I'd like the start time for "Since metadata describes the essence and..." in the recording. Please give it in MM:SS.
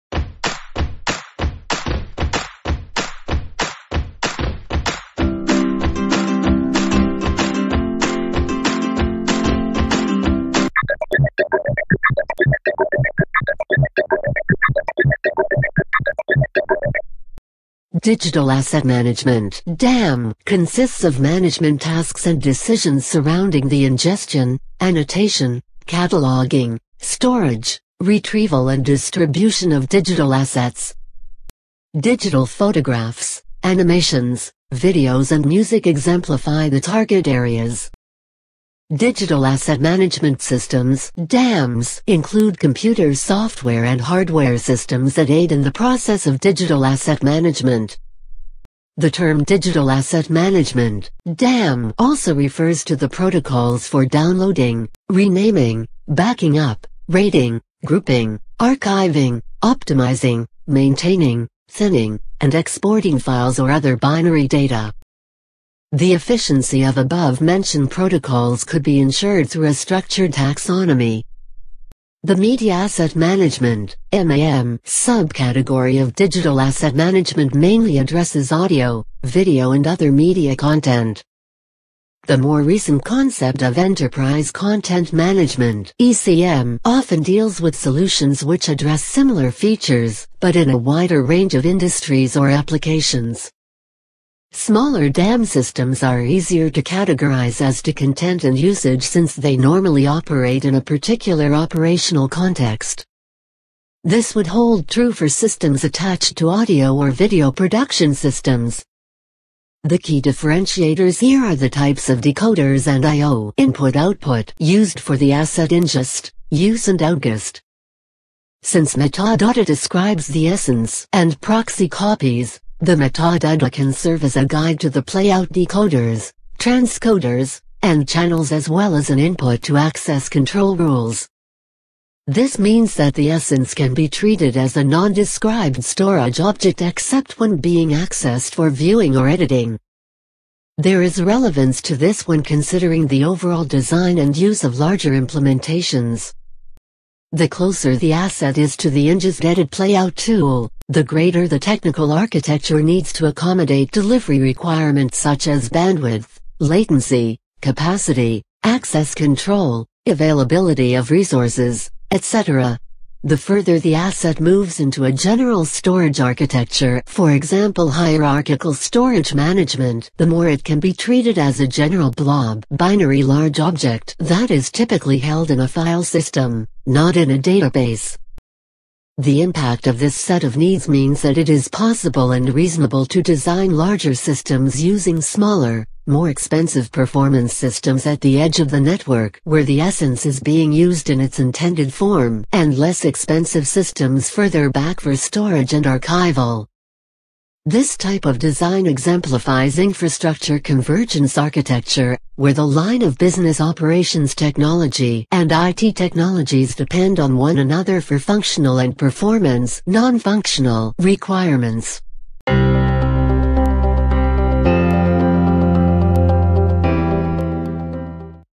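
01:58.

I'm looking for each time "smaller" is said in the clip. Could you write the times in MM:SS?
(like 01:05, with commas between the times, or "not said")
01:34, 03:05.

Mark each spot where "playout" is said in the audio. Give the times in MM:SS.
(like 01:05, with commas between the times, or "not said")
02:05, 02:29.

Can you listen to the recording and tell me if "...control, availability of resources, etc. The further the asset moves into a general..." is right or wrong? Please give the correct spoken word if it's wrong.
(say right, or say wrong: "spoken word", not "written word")
right.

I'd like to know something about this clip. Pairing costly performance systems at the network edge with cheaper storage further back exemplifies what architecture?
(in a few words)
infrastructure convergence.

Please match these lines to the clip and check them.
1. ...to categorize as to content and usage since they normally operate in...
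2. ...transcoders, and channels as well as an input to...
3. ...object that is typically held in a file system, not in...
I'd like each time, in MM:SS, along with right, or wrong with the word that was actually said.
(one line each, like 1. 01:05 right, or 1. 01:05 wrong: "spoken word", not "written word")
1. 01:36 right
2. 02:06 right
3. 02:53 right.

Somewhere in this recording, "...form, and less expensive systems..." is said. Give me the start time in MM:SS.
03:11.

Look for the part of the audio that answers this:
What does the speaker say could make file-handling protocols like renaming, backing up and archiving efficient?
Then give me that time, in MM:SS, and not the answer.
01:09.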